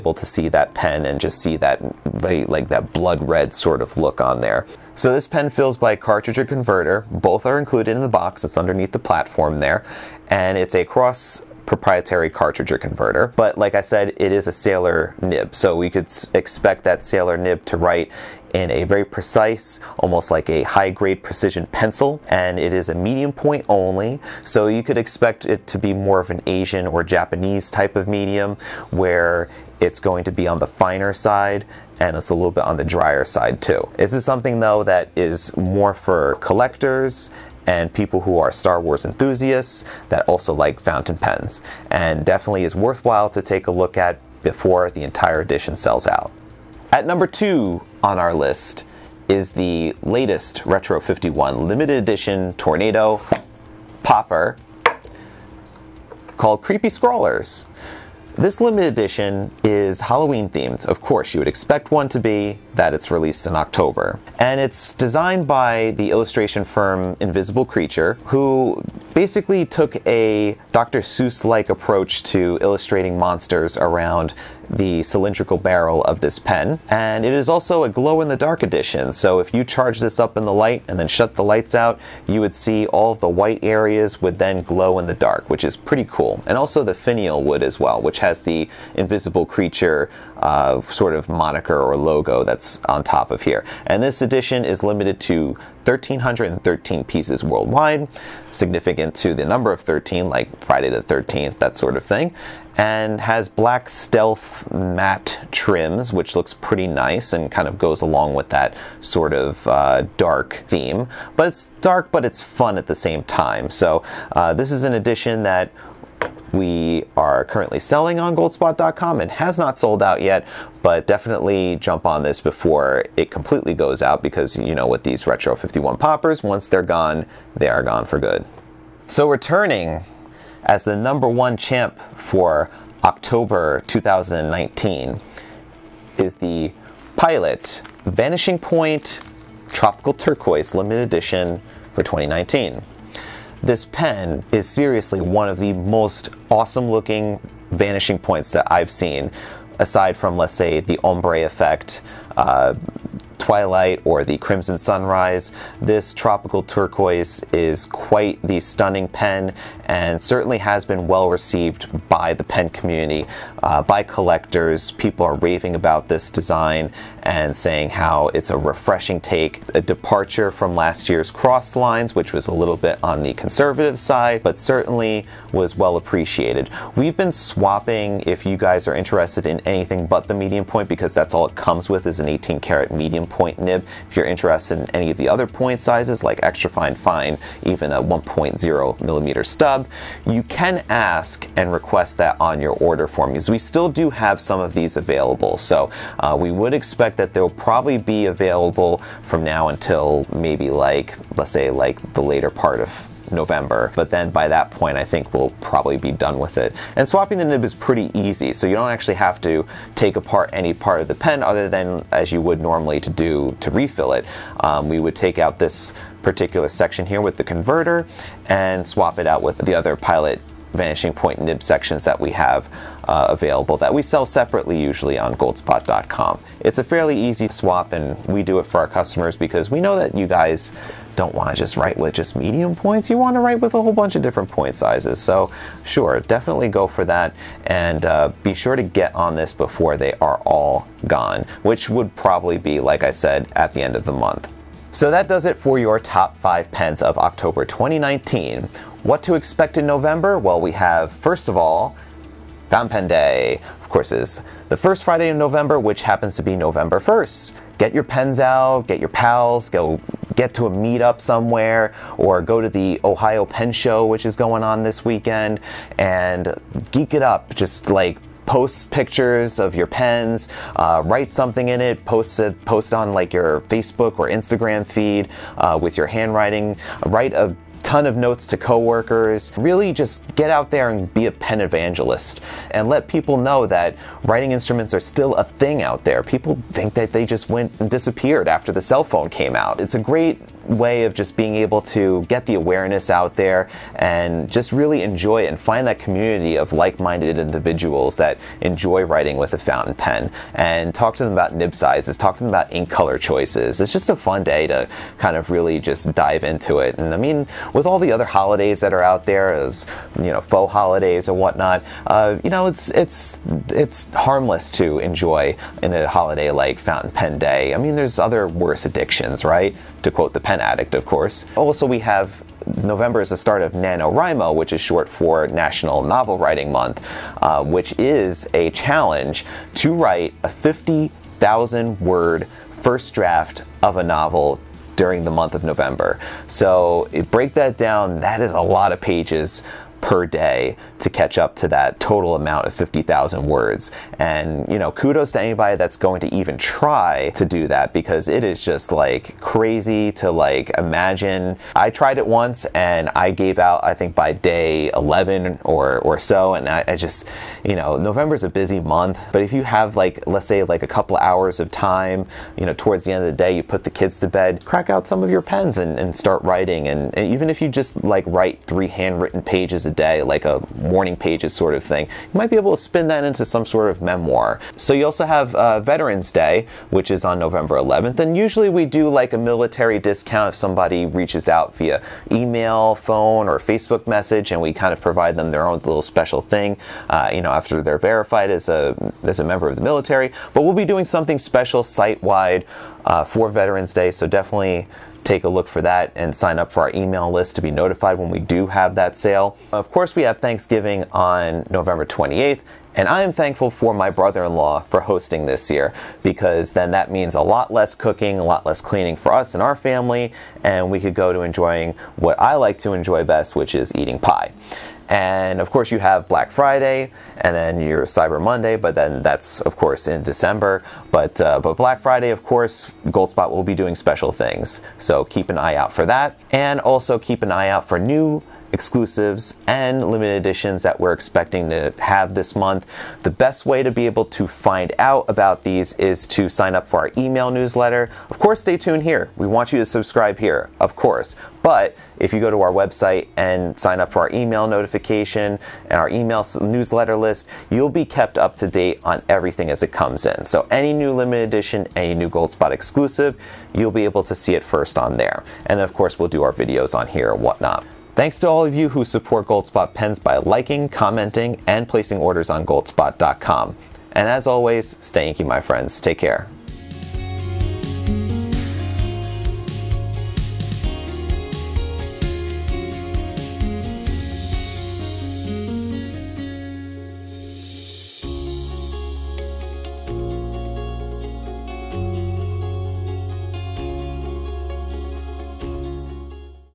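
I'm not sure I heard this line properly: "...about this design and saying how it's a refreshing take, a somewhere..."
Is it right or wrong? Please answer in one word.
wrong.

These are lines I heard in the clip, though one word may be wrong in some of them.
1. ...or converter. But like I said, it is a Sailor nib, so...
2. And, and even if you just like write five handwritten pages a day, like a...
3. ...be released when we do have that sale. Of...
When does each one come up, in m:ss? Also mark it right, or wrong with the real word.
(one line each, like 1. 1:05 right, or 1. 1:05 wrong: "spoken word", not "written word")
1. 0:12 right
2. 6:06 wrong: "three", not "five"
3. 6:37 wrong: "notified", not "released".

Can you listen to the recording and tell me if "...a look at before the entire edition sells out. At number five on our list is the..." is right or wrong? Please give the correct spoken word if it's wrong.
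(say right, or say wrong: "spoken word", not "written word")
wrong: "two", not "five".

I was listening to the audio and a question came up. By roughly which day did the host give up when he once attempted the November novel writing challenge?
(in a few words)
day 11.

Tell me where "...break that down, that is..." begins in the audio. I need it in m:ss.
5:37.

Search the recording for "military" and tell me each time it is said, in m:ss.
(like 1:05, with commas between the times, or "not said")
6:19, 6:29.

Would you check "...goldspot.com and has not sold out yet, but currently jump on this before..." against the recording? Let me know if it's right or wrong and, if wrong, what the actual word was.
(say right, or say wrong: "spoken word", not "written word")
wrong: "definitely", not "currently".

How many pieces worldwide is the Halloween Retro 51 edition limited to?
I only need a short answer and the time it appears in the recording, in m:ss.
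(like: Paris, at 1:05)
1,313, at 1:35.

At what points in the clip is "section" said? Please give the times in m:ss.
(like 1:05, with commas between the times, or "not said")
3:36, 3:41.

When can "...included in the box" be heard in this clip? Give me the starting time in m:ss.
0:07.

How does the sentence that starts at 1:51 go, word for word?
But it's dark, but it's fun at the same time.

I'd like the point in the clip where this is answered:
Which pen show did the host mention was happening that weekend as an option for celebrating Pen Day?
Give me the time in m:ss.
4:23.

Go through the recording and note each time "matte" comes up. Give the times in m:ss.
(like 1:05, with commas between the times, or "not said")
1:44.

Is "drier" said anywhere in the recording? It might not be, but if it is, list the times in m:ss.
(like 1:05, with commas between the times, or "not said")
0:32.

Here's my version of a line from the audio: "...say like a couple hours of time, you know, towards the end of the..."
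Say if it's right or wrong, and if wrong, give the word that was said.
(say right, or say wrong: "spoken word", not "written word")
right.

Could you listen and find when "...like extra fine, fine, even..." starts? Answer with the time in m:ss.
3:06.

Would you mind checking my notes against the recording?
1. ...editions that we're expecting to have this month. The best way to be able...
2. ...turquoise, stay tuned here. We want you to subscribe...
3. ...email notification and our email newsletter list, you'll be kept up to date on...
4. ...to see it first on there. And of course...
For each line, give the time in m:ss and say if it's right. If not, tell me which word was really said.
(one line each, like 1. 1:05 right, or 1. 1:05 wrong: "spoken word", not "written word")
1. 7:10 right
2. 7:18 wrong: "course", not "turquoise"
3. 7:24 right
4. 7:34 right.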